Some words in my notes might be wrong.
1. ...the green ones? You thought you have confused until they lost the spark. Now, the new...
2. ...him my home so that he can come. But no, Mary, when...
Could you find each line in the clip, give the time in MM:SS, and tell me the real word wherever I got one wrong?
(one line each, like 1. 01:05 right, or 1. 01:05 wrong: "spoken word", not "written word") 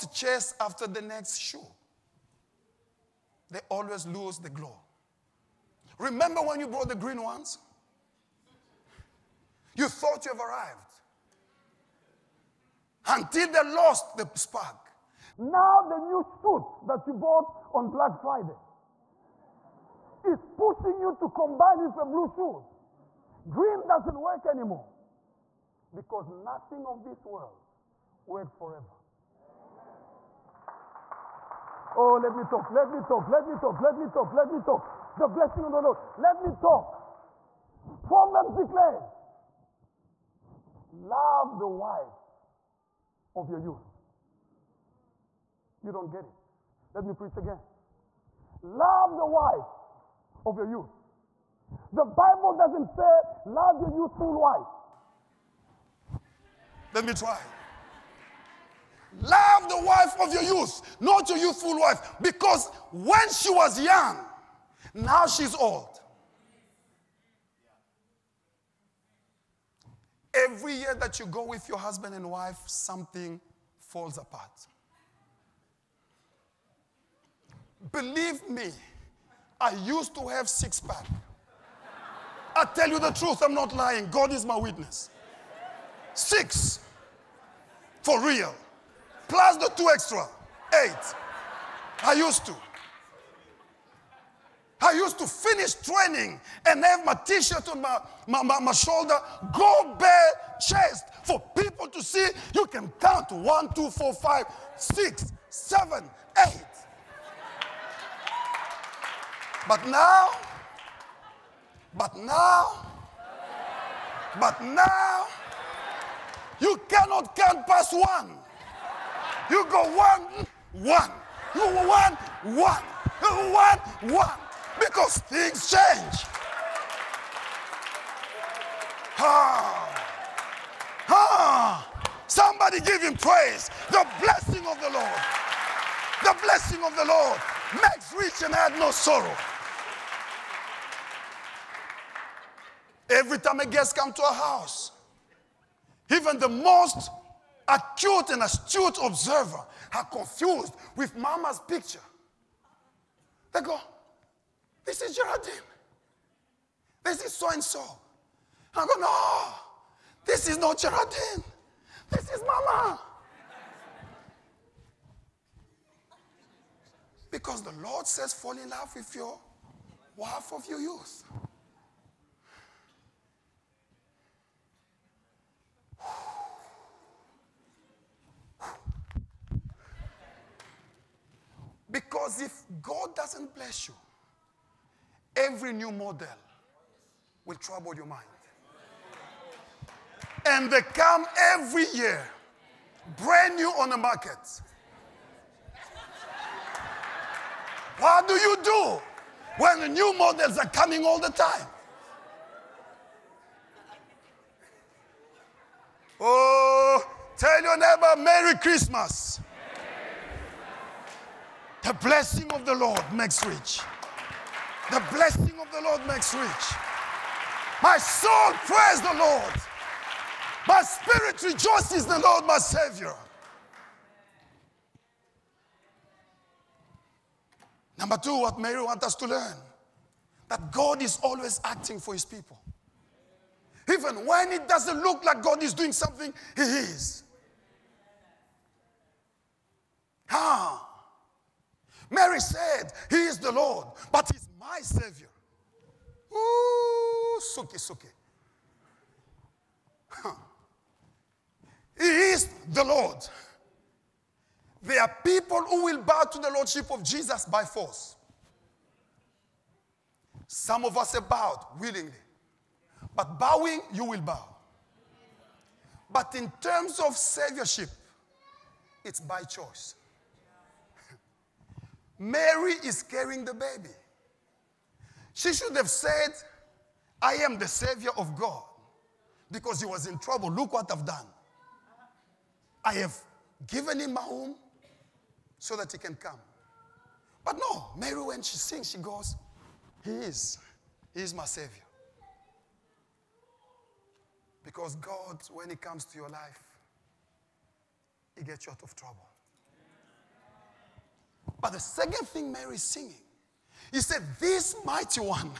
1. 00:06 wrong: "arrived", not "confused"
2. 04:44 right.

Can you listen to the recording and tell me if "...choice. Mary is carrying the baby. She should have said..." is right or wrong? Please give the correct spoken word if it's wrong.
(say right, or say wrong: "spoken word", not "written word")
right.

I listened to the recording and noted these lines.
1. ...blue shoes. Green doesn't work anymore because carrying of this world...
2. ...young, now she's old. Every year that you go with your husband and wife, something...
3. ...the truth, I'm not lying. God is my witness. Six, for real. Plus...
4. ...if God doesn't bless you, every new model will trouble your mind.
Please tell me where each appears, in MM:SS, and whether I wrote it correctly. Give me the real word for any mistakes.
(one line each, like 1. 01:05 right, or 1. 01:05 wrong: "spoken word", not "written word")
1. 00:22 wrong: "nothing", not "carrying"
2. 01:03 right
3. 01:22 right
4. 03:02 right.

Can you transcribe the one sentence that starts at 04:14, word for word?
There are people who will bow to the Lordship of Jesus by force.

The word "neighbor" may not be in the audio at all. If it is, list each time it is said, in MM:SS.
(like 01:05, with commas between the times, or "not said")
03:27.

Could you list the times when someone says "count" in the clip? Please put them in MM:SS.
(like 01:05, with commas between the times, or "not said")
01:43, 01:57.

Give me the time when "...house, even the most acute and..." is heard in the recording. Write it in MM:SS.
02:24.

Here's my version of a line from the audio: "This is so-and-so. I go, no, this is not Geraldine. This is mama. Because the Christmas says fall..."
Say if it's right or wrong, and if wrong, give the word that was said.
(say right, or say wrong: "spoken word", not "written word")
wrong: "Lord", not "Christmas".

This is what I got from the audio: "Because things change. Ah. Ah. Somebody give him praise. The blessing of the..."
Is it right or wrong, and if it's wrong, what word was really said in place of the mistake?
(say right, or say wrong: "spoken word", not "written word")
right.